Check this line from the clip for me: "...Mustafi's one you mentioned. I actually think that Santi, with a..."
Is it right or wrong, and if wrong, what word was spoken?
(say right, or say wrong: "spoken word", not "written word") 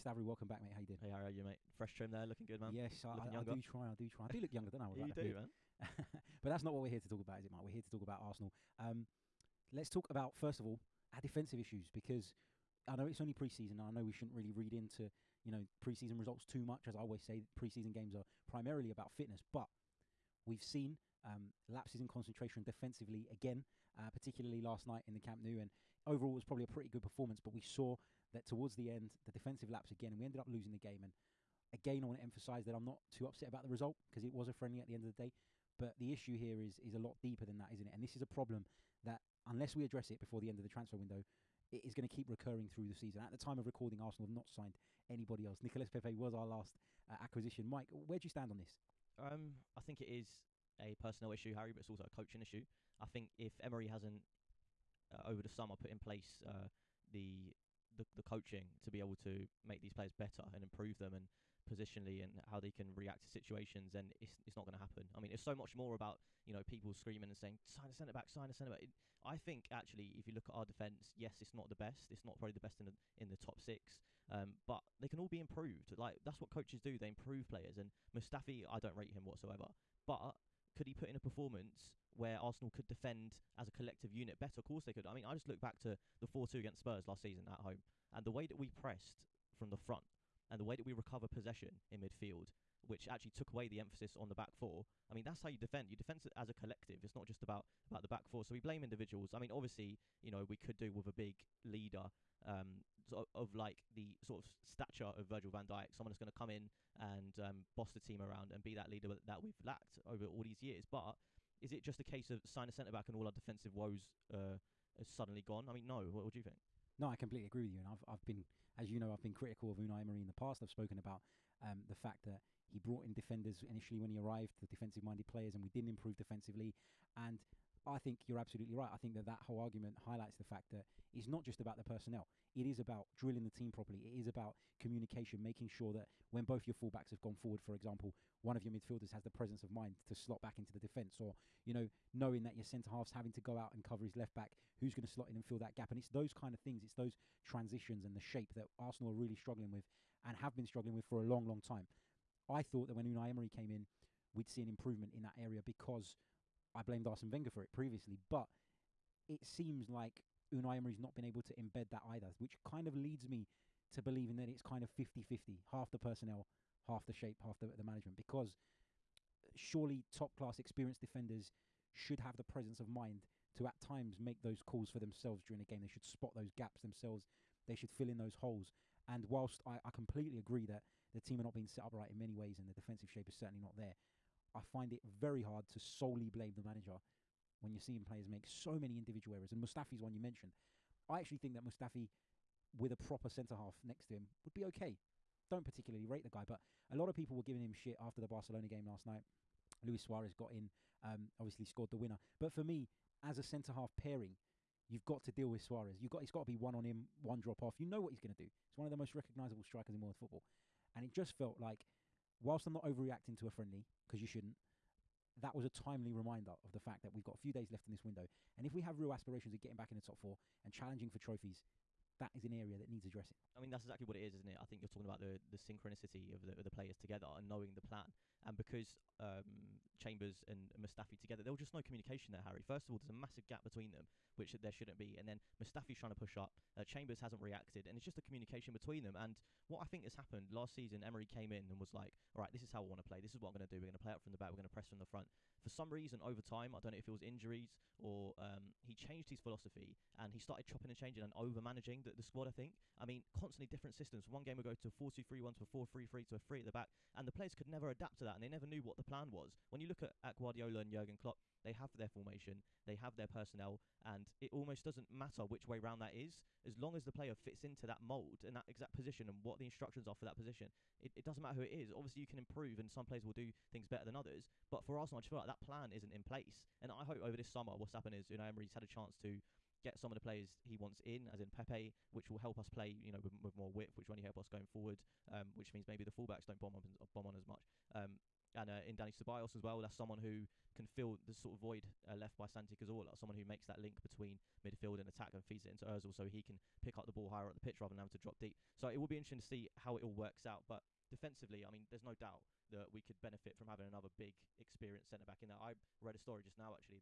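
wrong: "Mustafi", not "Santi".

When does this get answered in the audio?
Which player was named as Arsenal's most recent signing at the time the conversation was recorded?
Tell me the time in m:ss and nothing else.
0:45.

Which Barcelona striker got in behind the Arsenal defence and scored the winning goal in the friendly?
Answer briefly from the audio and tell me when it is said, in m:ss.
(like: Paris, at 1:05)
Luis Suarez, at 3:19.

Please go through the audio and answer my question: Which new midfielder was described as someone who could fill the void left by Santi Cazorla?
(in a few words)
Dani Ceballos.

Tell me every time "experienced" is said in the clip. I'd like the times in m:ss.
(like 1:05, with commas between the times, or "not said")
2:50, 5:04.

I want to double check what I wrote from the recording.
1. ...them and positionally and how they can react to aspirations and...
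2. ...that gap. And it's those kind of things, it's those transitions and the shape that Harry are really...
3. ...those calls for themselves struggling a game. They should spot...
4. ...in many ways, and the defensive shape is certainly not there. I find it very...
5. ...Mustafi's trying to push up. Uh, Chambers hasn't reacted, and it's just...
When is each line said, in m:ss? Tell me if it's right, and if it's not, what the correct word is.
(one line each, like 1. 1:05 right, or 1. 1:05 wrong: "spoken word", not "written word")
1. 1:00 wrong: "situations", not "aspirations"
2. 2:25 wrong: "Arsenal", not "Harry"
3. 2:54 wrong: "during", not "struggling"
4. 3:02 right
5. 3:55 right.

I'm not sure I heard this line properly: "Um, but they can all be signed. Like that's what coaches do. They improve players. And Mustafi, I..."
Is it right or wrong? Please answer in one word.
wrong.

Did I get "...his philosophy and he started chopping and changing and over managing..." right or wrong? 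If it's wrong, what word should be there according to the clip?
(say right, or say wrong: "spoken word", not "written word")
right.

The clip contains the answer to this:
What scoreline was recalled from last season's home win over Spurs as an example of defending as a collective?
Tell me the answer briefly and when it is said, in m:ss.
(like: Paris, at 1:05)
4-2, at 1:26.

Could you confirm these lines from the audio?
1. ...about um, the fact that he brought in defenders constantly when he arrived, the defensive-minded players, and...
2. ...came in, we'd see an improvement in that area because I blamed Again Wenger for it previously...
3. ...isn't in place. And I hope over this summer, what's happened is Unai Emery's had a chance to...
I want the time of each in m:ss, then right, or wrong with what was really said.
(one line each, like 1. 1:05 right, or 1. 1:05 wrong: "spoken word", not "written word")
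1. 2:00 wrong: "initially", not "constantly"
2. 2:33 wrong: "Arsene", not "Again"
3. 4:35 right.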